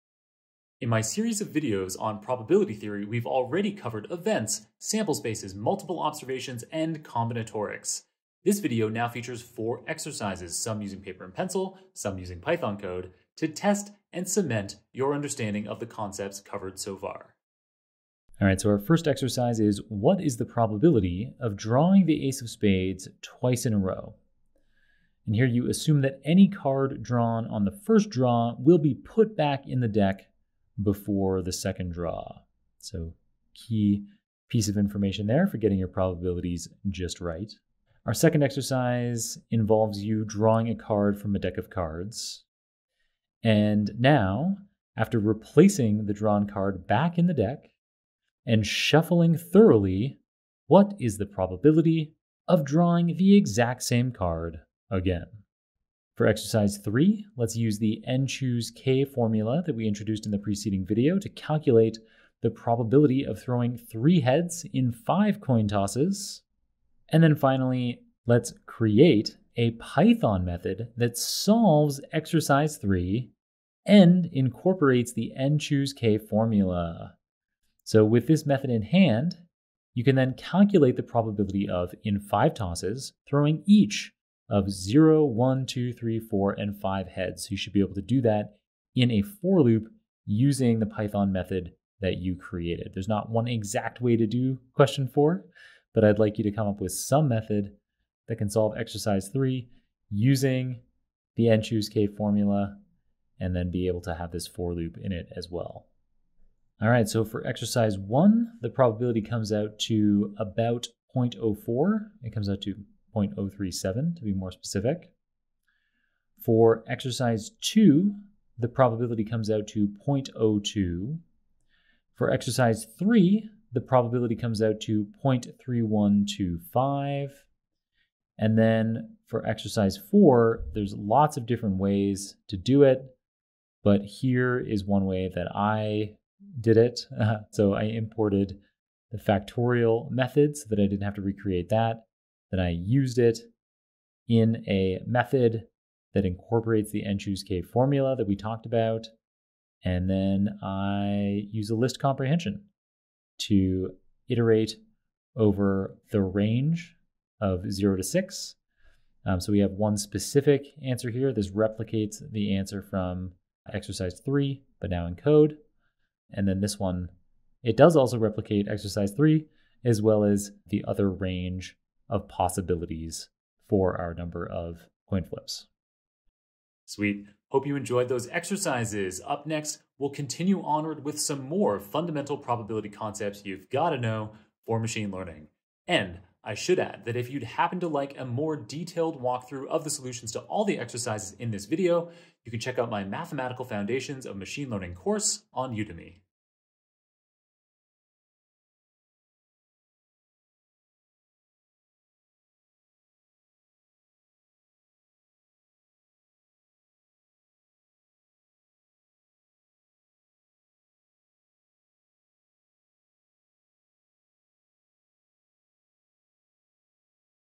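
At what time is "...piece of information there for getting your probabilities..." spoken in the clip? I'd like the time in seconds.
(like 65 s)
34 s.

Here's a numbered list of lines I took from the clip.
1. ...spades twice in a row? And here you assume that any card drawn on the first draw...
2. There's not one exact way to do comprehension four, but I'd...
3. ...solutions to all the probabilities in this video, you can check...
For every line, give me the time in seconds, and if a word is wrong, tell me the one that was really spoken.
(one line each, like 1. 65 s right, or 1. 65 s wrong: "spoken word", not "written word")
1. 22 s right
2. 92 s wrong: "question", not "comprehension"
3. 189 s wrong: "exercises", not "probabilities".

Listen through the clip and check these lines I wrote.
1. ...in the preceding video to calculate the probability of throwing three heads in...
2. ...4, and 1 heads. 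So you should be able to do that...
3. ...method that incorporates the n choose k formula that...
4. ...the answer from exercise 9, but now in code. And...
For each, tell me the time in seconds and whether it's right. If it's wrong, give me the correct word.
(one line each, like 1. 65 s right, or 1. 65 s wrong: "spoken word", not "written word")
1. 60 s right
2. 86 s wrong: "5", not "1"
3. 145 s right
4. 162 s wrong: "3", not "9".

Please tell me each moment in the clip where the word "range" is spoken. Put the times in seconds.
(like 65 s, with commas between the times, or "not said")
156 s, 171 s.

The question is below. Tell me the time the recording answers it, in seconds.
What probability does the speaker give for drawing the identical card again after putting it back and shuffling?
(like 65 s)
120 s.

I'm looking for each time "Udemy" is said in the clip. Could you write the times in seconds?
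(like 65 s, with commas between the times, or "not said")
195 s.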